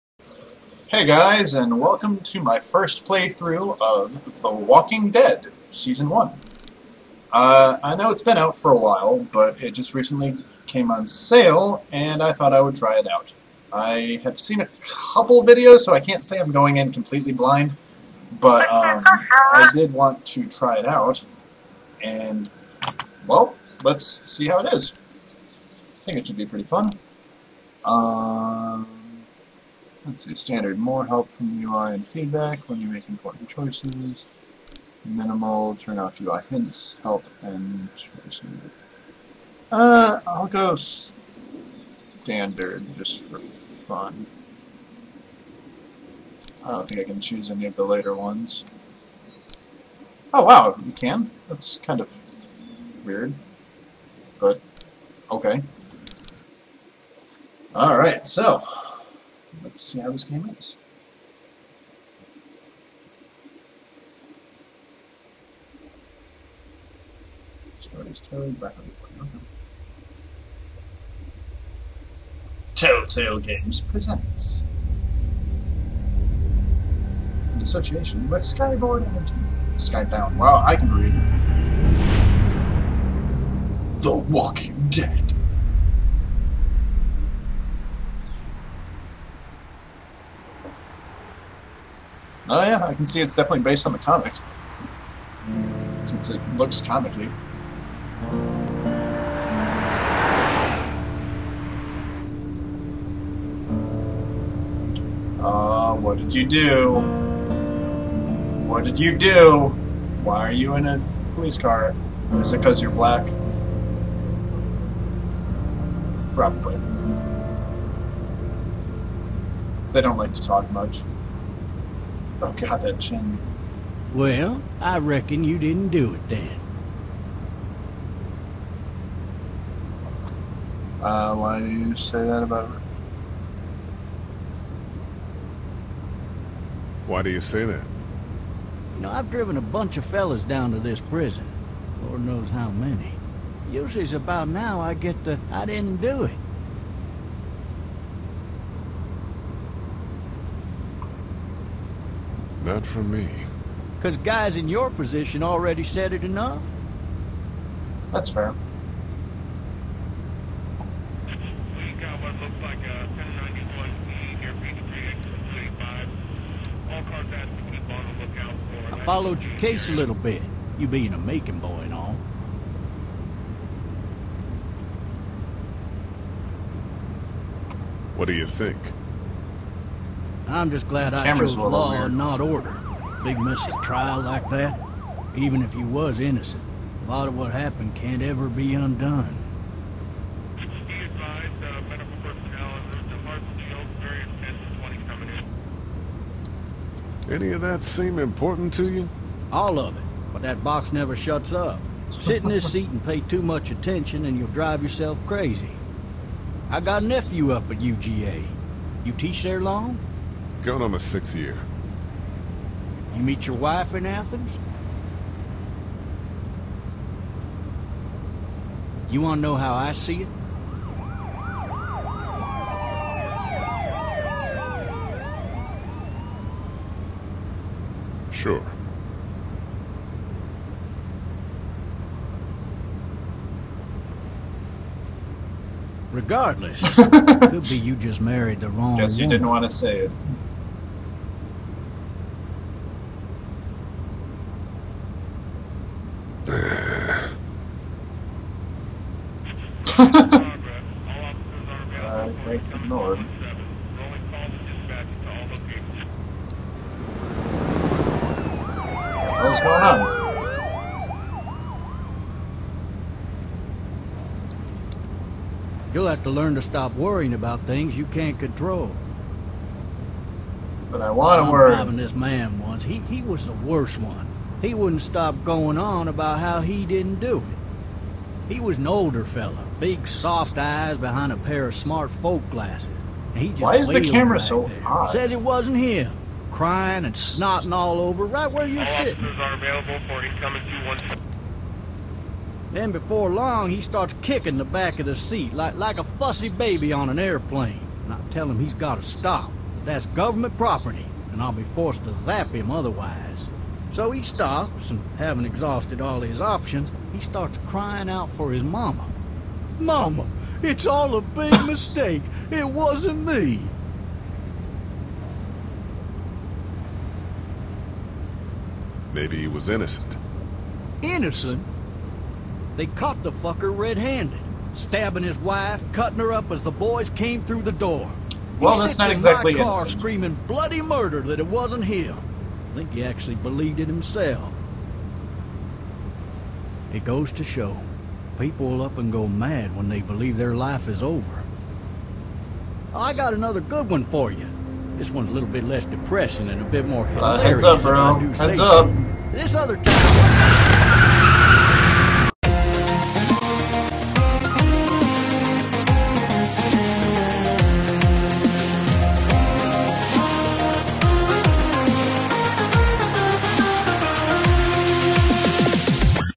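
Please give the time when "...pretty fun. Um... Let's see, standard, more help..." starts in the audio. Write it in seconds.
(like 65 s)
26 s.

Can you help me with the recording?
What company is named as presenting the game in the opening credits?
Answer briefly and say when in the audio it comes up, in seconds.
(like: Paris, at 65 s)
Telltale Games, at 72 s.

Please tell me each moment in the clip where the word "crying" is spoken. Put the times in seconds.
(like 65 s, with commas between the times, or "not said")
286 s, 307 s.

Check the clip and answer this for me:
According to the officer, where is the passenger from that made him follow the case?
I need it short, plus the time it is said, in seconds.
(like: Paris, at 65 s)
Macon, at 171 s.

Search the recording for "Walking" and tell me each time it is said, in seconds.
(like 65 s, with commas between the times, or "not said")
4 s, 84 s.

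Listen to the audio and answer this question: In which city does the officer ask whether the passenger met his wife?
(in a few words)
Athens.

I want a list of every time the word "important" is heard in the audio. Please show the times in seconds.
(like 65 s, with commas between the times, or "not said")
33 s, 198 s.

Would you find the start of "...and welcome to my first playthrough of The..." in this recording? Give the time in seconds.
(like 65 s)
1 s.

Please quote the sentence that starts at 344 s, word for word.
This one's a little bit less depressing and a bit more hilarious.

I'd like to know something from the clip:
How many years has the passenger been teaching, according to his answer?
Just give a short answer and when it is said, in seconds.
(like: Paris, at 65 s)
6, at 210 s.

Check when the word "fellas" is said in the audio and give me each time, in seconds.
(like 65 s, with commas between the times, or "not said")
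140 s, 279 s.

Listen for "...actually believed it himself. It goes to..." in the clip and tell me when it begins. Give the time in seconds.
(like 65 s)
333 s.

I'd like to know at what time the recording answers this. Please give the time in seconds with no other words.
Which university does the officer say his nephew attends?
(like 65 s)
207 s.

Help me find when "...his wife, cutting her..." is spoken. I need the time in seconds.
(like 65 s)
325 s.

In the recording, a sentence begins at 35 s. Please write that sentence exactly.
Minimal, turn off UI hints, help, and Uh, I'll go standard just for fun.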